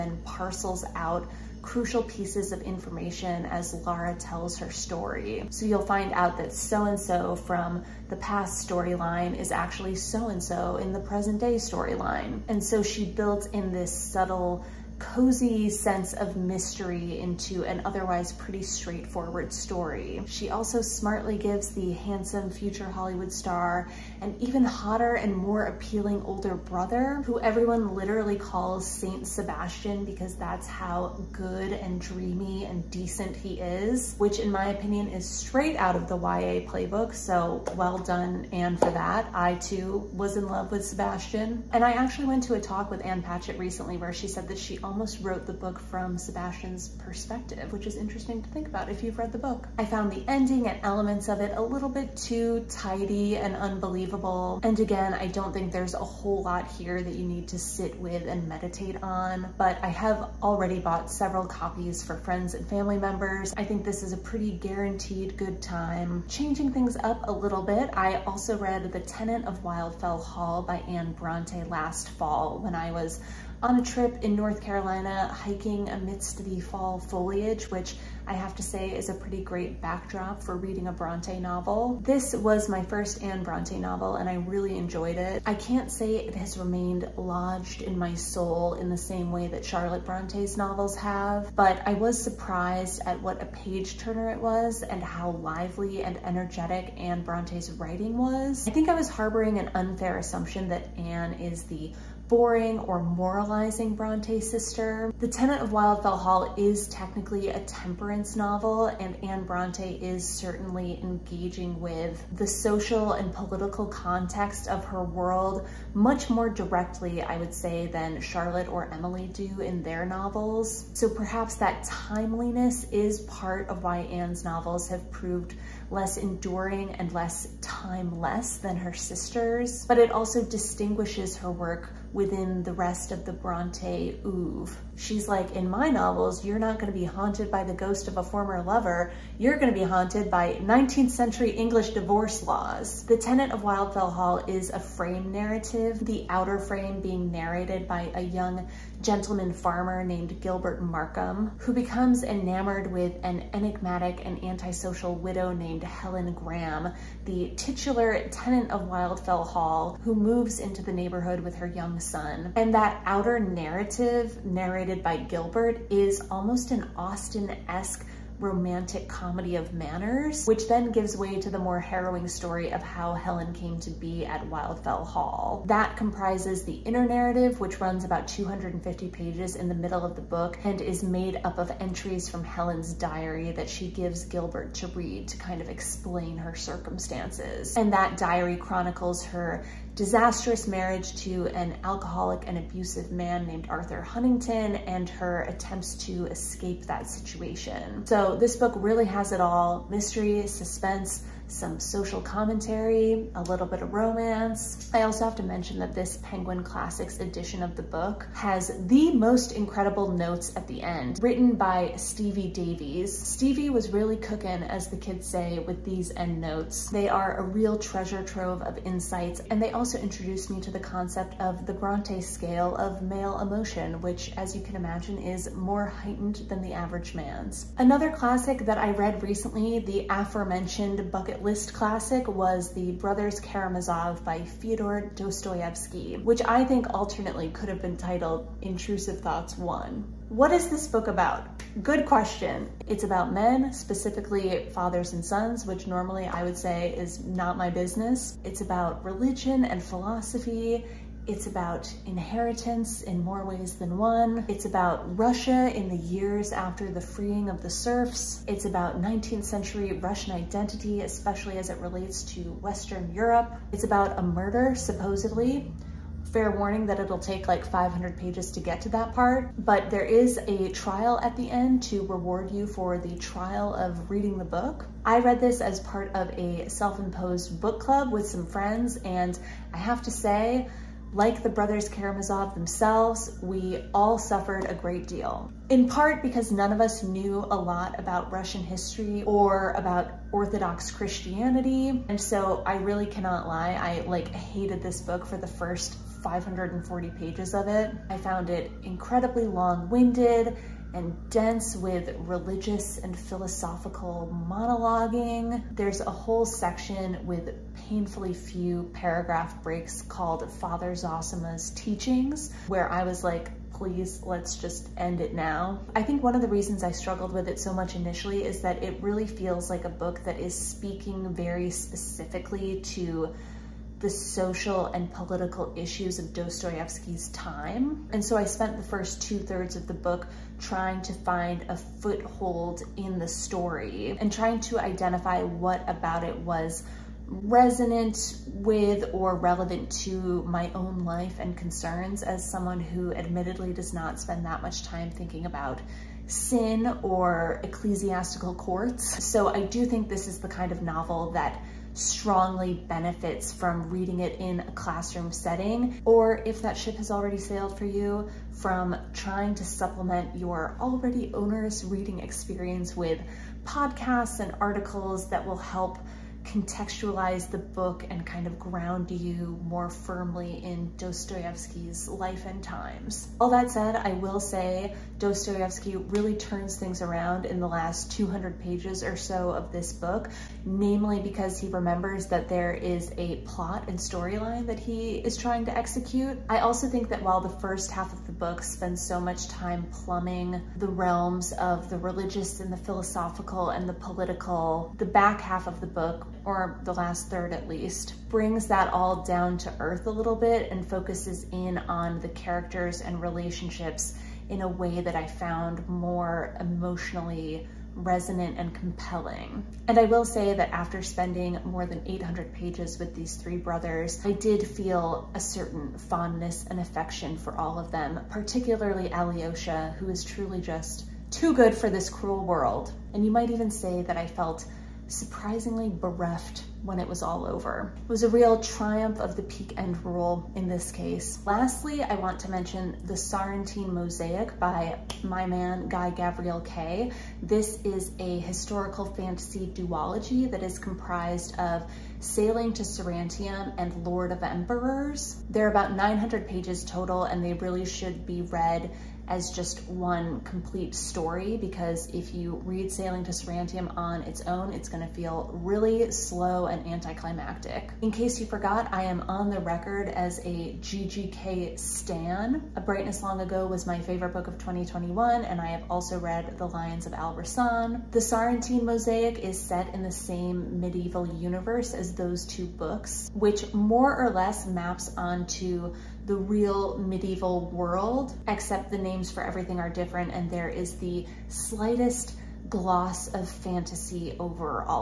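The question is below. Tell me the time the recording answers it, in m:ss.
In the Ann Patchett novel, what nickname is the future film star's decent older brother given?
0:28.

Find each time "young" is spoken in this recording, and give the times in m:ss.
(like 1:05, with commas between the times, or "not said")
2:28, 2:41.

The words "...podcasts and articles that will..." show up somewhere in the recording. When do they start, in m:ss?
6:03.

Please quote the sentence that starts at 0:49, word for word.
I found the ending and elements of it a little bit too tidy and unbelievable.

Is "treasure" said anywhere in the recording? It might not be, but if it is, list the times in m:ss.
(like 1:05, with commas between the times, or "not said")
3:37.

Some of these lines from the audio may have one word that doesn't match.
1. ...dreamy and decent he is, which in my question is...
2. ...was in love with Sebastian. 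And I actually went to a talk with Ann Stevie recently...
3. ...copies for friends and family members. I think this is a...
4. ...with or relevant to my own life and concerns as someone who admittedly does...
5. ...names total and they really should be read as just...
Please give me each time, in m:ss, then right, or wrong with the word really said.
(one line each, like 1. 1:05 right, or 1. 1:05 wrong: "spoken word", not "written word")
1. 0:31 wrong: "opinion", not "question"
2. 0:40 wrong: "Patchett", not "Stevie"
3. 1:01 right
4. 5:38 right
5. 7:26 wrong: "pages", not "names".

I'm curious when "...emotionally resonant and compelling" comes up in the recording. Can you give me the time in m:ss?
6:46.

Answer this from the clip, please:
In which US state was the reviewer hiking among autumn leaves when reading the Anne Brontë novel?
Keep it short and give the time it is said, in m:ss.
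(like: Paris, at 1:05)
North Carolina, at 1:14.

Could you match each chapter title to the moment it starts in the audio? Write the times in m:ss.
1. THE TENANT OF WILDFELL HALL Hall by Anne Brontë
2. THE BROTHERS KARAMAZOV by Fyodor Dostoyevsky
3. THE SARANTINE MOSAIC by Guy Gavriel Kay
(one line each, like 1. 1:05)
1. 1:06
2. 3:48
3. 7:11.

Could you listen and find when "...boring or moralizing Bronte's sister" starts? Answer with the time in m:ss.
1:42.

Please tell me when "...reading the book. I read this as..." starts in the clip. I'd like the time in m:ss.
4:34.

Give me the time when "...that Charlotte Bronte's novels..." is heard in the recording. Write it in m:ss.
1:29.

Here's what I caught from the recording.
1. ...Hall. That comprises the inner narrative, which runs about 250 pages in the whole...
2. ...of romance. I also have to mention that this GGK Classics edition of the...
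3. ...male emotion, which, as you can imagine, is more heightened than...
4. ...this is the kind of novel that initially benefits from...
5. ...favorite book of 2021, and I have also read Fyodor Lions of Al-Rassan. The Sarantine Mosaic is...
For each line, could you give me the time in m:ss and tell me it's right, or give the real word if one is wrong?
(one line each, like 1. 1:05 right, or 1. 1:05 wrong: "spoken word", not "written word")
1. 2:55 wrong: "middle", not "whole"
2. 3:23 wrong: "Penguin", not "GGK"
3. 3:43 right
4. 5:50 wrong: "strongly", not "initially"
5. 7:43 wrong: "The", not "Fyodor".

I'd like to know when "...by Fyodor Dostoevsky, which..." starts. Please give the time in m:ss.
3:54.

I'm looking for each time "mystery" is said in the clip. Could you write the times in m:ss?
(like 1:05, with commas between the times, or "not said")
0:16, 3:19.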